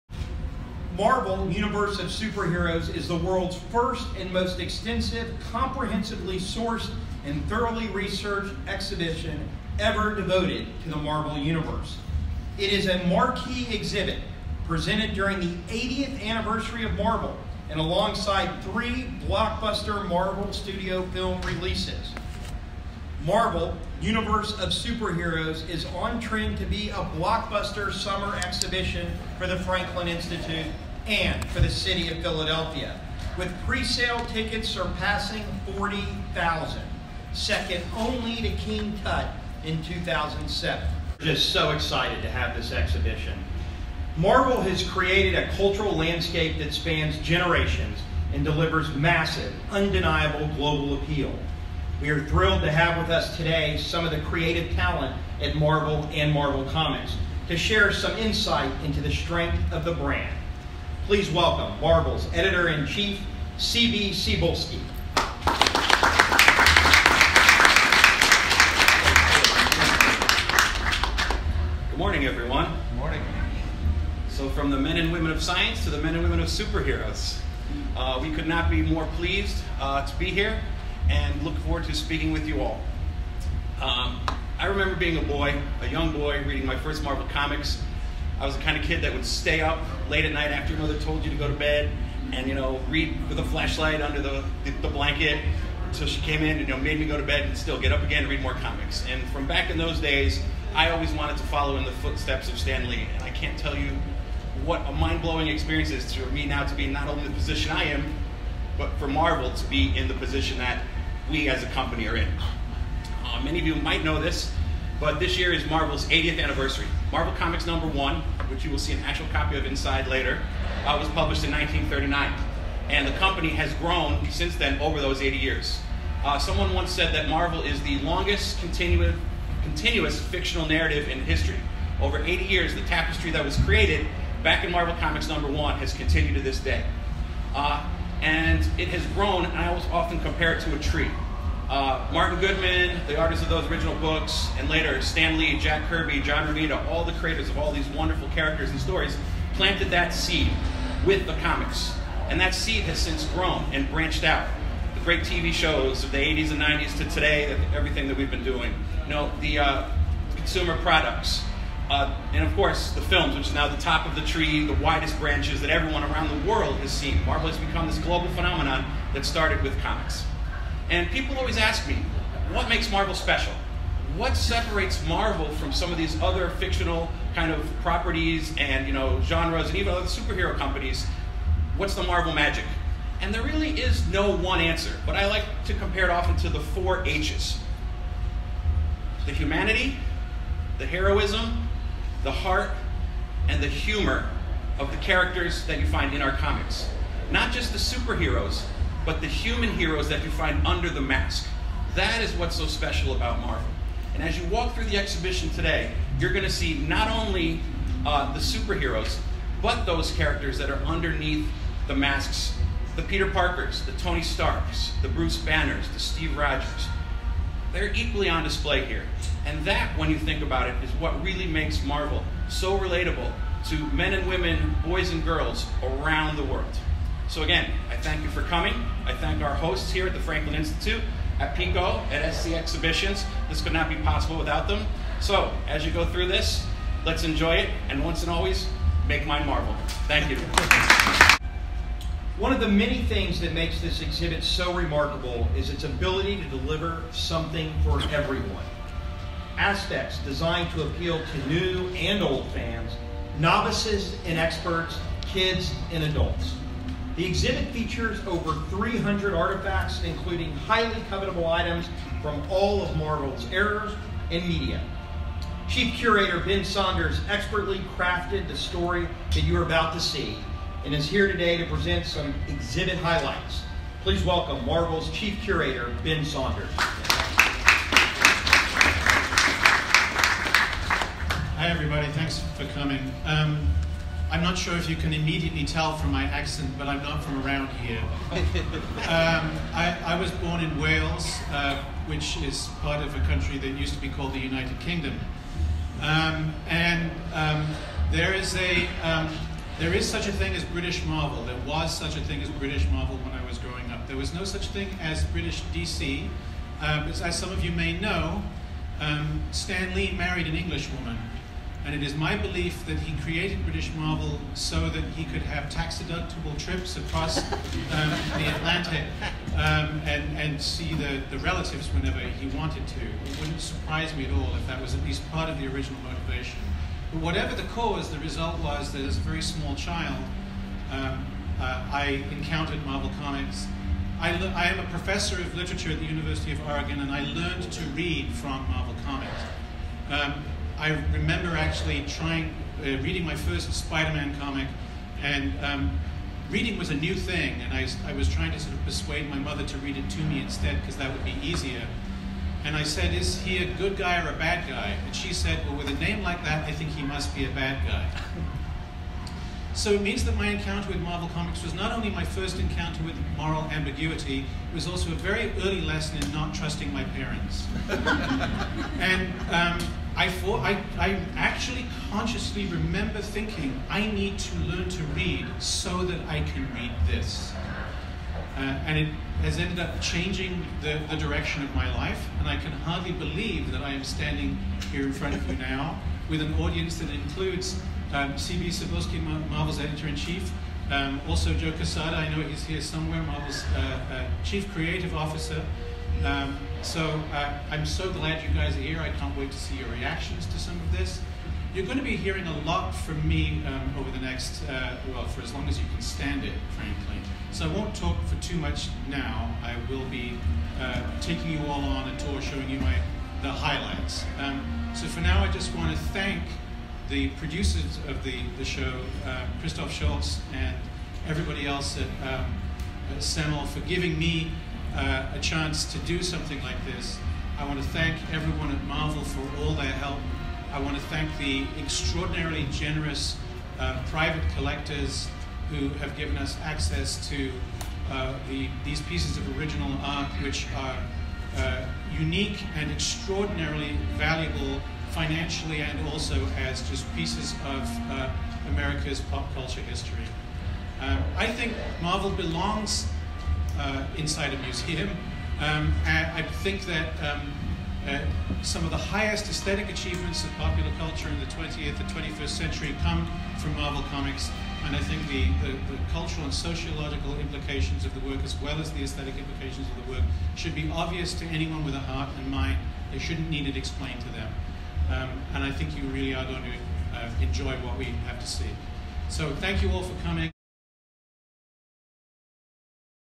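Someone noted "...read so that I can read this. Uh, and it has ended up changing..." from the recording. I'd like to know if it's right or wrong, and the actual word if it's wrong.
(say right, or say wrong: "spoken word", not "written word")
right.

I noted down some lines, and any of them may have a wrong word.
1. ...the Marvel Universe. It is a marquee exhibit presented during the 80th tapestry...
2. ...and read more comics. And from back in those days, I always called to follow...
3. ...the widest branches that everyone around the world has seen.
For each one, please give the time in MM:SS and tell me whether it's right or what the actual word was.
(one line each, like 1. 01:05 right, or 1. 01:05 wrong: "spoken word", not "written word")
1. 00:10 wrong: "anniversary", not "tapestry"
2. 01:38 wrong: "wanted", not "called"
3. 02:44 right.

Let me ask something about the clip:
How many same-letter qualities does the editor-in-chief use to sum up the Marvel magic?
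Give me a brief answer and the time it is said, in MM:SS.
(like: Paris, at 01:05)
4, at 03:06.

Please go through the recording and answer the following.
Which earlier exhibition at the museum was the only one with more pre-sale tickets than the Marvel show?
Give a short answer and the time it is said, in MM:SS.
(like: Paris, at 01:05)
King Tut, at 00:38.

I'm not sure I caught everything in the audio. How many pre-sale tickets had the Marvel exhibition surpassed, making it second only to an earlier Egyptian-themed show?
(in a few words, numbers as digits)
40,000.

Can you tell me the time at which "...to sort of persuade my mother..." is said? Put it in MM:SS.
05:48.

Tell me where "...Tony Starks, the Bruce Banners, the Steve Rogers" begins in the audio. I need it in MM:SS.
03:33.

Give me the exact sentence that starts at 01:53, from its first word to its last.
Uh, many of you might know this, but this year is Marvel's 80th anniversary.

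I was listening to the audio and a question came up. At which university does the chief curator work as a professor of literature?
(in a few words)
University of Oregon.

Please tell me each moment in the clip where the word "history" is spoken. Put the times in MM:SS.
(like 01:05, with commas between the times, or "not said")
02:11, 07:29.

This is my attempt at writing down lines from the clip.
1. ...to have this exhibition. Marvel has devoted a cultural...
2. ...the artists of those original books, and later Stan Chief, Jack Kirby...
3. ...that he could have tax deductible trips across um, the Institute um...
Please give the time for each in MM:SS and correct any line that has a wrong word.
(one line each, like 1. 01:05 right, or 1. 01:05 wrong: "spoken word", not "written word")
1. 00:42 wrong: "created", not "devoted"
2. 02:23 wrong: "Lee", not "Chief"
3. 05:14 wrong: "Atlantic", not "Institute".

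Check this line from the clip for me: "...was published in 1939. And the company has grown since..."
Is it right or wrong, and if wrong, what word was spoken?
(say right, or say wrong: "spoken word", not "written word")
right.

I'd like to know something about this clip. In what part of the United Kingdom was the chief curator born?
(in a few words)
Wales.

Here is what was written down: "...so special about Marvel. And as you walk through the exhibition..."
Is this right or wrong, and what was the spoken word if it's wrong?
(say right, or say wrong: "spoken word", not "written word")
right.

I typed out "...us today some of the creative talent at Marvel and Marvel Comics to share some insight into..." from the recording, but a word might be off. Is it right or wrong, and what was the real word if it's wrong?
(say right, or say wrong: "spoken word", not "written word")
right.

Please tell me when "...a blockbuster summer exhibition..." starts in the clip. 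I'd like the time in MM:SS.
00:26.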